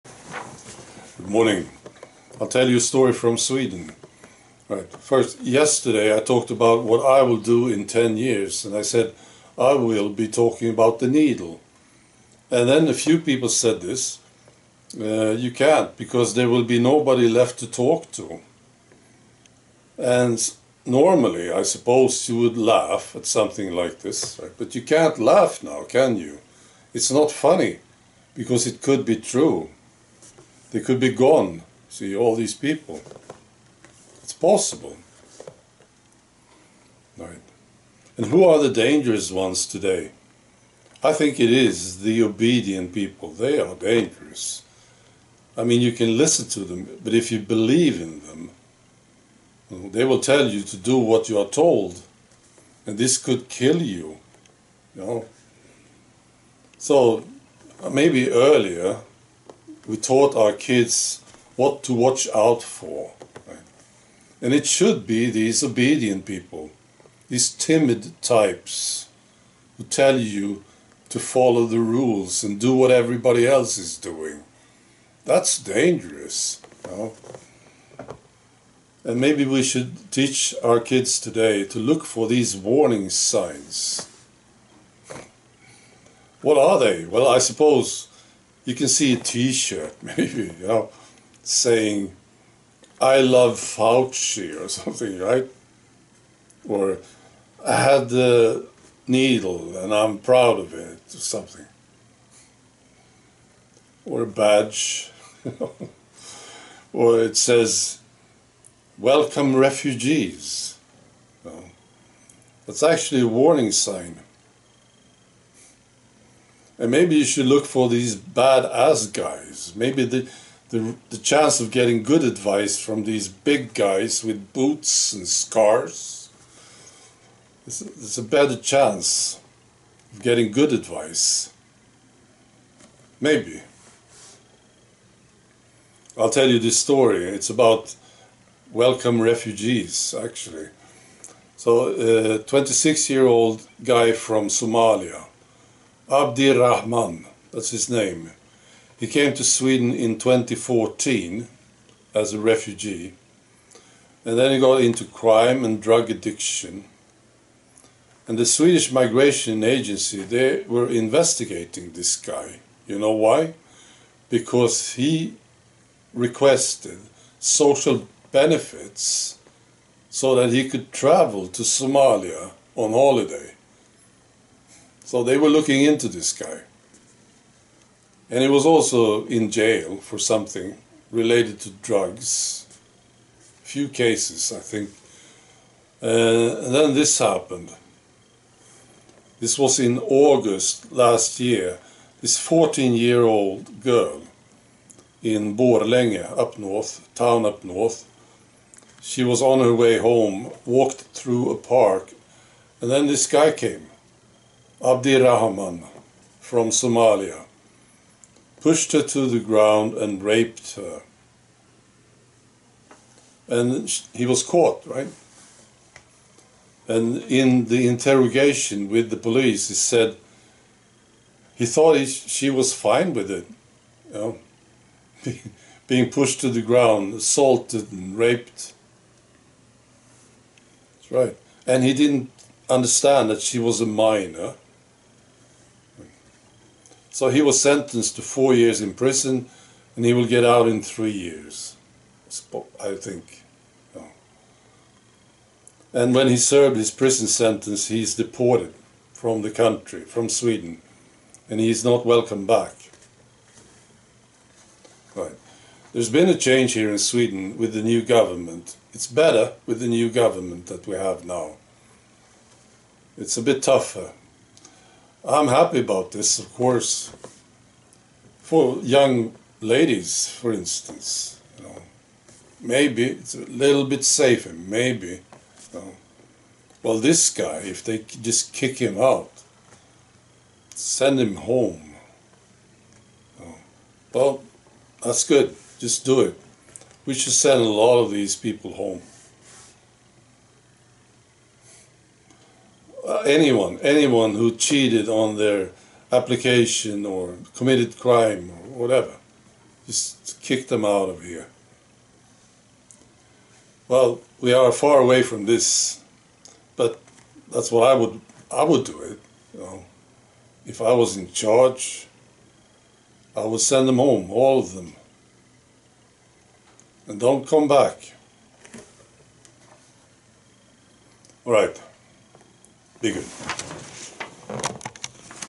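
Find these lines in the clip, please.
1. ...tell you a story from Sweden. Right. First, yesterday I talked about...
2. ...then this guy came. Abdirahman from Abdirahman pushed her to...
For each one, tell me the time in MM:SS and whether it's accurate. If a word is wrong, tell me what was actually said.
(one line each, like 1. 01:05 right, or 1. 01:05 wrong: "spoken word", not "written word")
1. 00:02 right
2. 03:22 wrong: "Somalia", not "Abdirahman".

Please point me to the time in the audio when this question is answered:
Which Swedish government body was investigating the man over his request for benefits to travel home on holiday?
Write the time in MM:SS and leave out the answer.
02:38.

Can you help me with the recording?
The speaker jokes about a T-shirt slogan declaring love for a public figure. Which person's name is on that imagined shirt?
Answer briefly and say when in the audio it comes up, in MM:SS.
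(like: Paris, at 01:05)
Fauci, at 01:33.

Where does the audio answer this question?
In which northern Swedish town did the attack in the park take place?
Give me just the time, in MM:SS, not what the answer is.
03:15.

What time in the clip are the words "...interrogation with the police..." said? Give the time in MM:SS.
03:37.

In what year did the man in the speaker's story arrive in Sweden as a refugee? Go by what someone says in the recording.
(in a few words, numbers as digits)
2014.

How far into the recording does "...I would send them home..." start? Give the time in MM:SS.
05:13.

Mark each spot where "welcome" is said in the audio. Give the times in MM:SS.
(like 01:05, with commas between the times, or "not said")
01:48, 02:18, 04:12.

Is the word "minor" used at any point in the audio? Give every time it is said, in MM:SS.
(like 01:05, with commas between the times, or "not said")
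03:53.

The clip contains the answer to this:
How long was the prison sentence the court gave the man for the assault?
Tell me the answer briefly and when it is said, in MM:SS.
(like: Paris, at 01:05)
4 years, at 03:58.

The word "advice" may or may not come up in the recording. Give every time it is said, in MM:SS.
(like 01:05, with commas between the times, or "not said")
02:02, 02:10.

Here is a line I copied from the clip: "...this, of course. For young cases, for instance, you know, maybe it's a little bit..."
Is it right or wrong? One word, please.
wrong.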